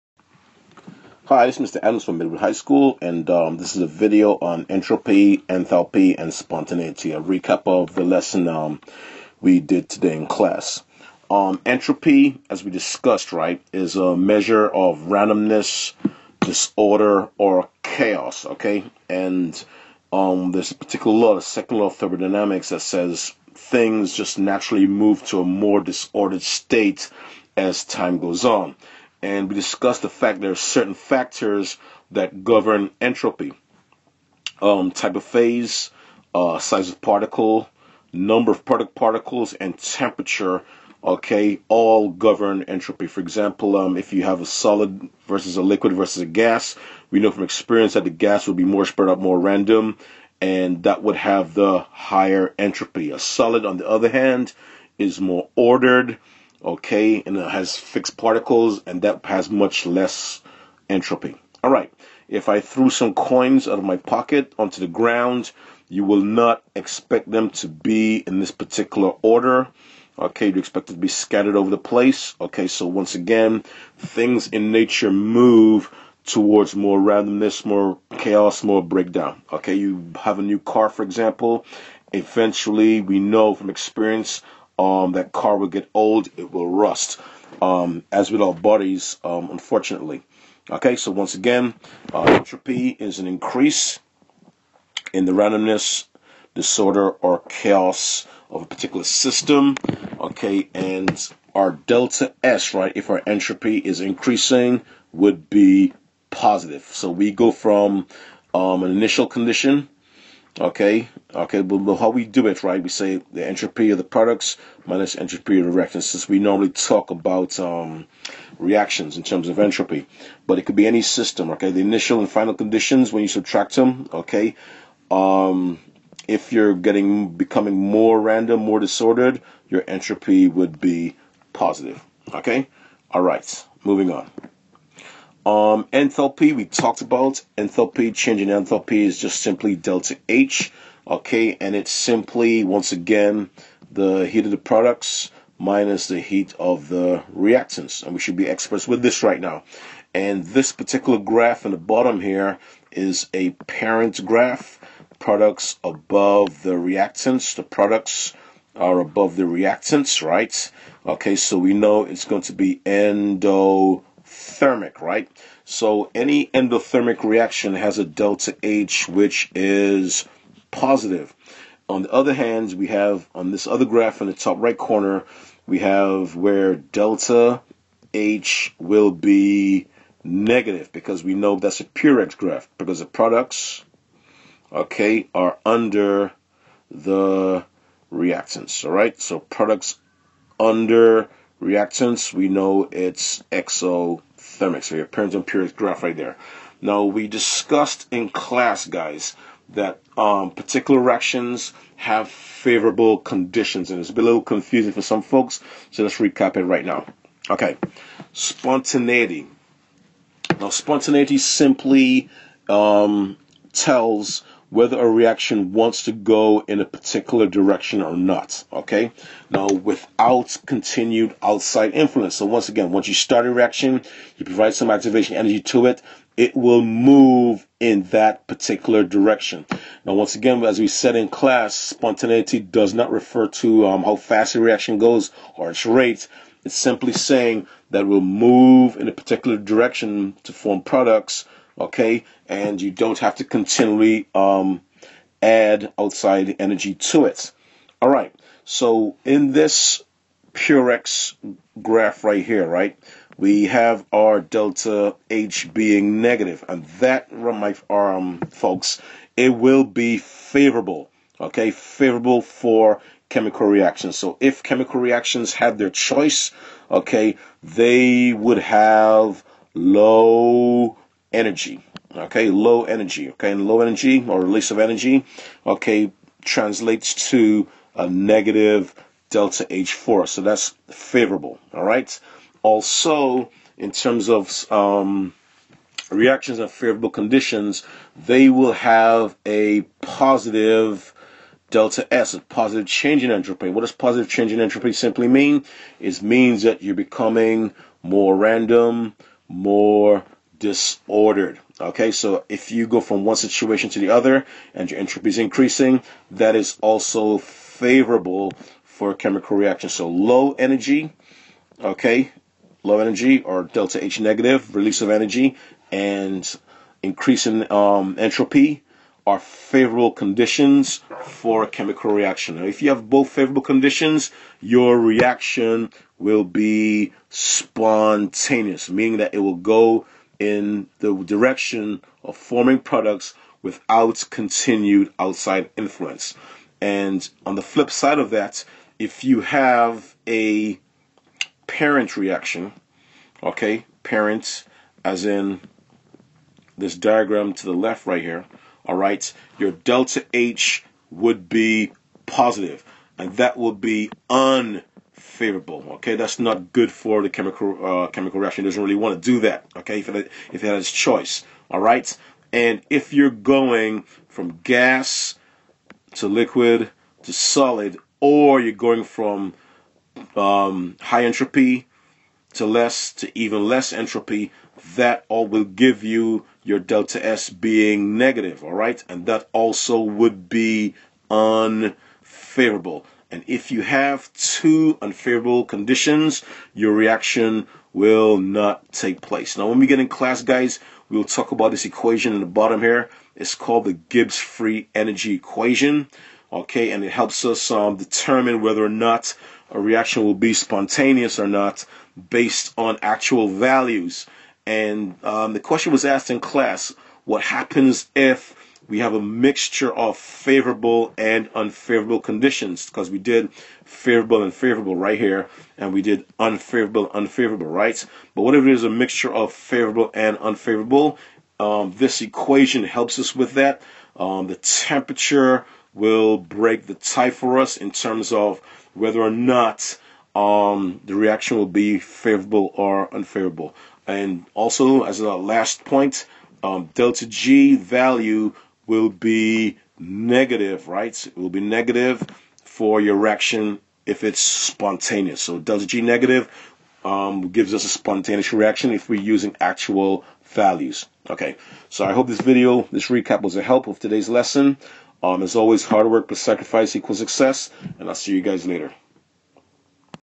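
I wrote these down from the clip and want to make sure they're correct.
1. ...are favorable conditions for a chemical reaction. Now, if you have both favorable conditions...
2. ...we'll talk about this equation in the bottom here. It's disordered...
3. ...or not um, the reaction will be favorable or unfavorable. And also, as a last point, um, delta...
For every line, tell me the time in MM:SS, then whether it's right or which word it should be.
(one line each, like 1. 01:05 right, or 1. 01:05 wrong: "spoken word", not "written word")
1. 05:19 right
2. 06:31 wrong: "called", not "disordered"
3. 07:09 right.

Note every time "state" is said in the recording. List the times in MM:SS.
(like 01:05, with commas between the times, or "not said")
00:26.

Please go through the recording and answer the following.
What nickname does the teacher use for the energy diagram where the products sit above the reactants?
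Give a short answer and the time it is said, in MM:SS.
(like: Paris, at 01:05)
parent graph, at 02:33.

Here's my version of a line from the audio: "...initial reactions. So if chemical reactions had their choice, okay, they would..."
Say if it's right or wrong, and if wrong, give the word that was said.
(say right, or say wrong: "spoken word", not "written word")
wrong: "chemical", not "initial".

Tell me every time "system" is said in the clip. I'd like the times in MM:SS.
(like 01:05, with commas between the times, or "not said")
01:39, 02:01.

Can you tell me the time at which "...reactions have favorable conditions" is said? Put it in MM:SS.
03:20.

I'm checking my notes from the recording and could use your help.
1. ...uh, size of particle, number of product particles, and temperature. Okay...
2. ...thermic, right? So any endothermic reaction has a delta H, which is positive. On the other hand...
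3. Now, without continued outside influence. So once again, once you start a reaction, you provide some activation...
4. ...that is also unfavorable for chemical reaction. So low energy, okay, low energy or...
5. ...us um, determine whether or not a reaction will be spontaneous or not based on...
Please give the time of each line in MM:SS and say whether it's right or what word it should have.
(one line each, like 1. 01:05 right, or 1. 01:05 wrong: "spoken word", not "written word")
1. 00:36 right
2. 02:44 right
3. 03:39 right
4. 05:06 wrong: "favorable", not "unfavorable"
5. 06:37 right.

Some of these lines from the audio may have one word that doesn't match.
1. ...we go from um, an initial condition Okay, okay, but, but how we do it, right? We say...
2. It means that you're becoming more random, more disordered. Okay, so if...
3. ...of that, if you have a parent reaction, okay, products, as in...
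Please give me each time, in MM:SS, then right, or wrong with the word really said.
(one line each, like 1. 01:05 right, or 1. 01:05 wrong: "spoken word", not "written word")
1. 01:47 right
2. 04:55 right
3. 05:38 wrong: "parents", not "products".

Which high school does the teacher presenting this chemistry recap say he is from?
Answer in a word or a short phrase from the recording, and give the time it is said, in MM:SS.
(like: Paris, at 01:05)
Midwood High School, at 00:02.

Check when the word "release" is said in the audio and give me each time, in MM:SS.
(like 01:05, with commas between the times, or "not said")
04:34, 05:14.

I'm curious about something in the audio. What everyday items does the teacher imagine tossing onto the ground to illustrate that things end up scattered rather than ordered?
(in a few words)
coins.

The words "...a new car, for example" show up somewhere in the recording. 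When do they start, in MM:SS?
01:20.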